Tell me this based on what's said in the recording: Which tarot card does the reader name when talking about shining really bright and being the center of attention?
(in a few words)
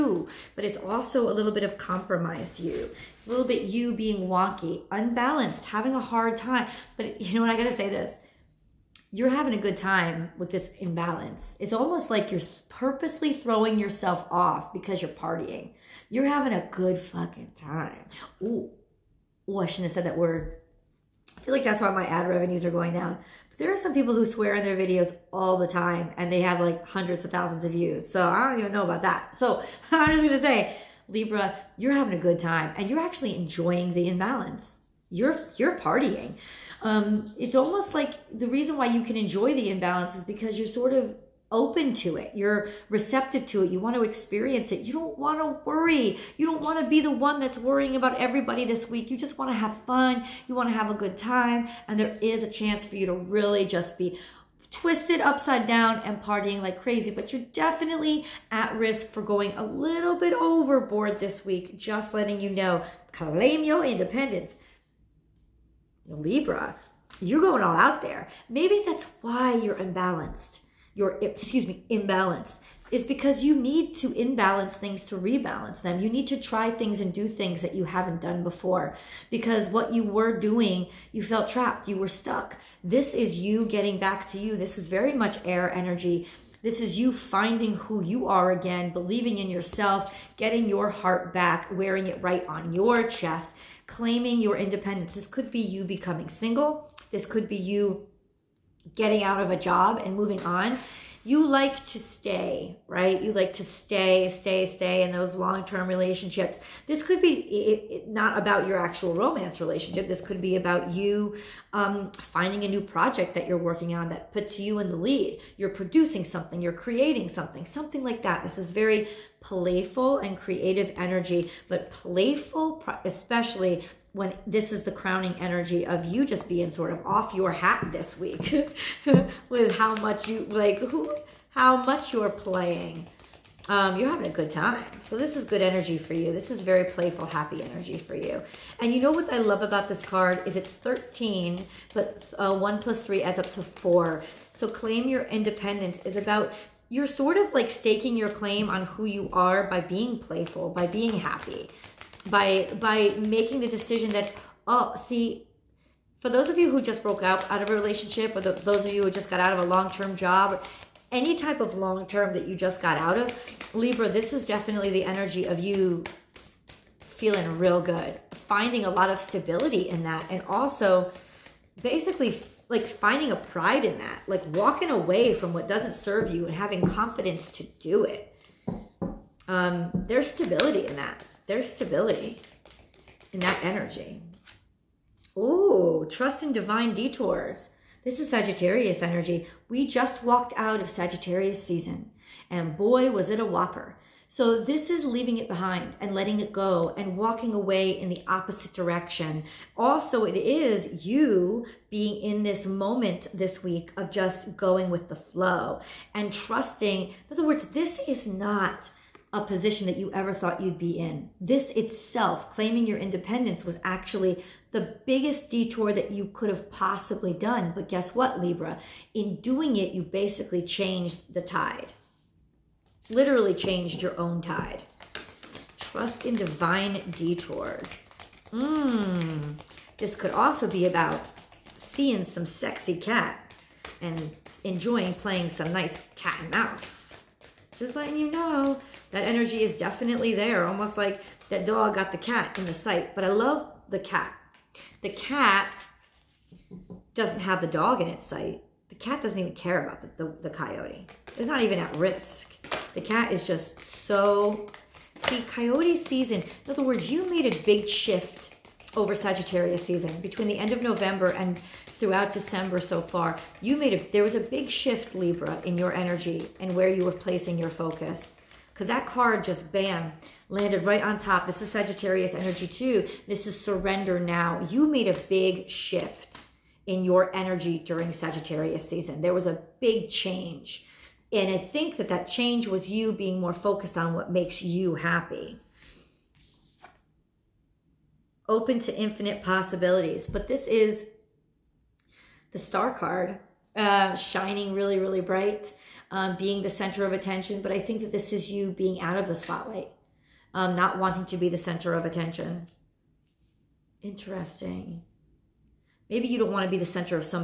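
The Star.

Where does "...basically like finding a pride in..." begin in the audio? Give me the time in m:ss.
2:51.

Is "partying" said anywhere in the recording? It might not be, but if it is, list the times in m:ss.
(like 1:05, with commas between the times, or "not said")
0:15, 0:35, 0:56.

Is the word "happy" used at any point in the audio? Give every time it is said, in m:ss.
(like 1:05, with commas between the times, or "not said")
2:17, 2:31, 4:44.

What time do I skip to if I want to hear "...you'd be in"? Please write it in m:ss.
3:30.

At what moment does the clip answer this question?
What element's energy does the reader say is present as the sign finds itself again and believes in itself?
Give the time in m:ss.
1:25.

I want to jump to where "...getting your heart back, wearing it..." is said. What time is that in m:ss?
1:30.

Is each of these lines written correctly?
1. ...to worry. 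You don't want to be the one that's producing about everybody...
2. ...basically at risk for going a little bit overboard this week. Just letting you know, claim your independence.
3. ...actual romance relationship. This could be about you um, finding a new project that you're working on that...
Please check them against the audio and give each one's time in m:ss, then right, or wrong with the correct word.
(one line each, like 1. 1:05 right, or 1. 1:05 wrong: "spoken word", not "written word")
1. 0:45 wrong: "worrying", not "producing"
2. 0:57 wrong: "definitely", not "basically"
3. 1:48 right.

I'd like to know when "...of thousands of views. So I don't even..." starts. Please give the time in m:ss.
0:27.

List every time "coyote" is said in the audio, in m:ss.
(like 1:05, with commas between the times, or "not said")
4:10, 4:15.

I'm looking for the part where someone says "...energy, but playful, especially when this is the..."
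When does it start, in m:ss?
2:00.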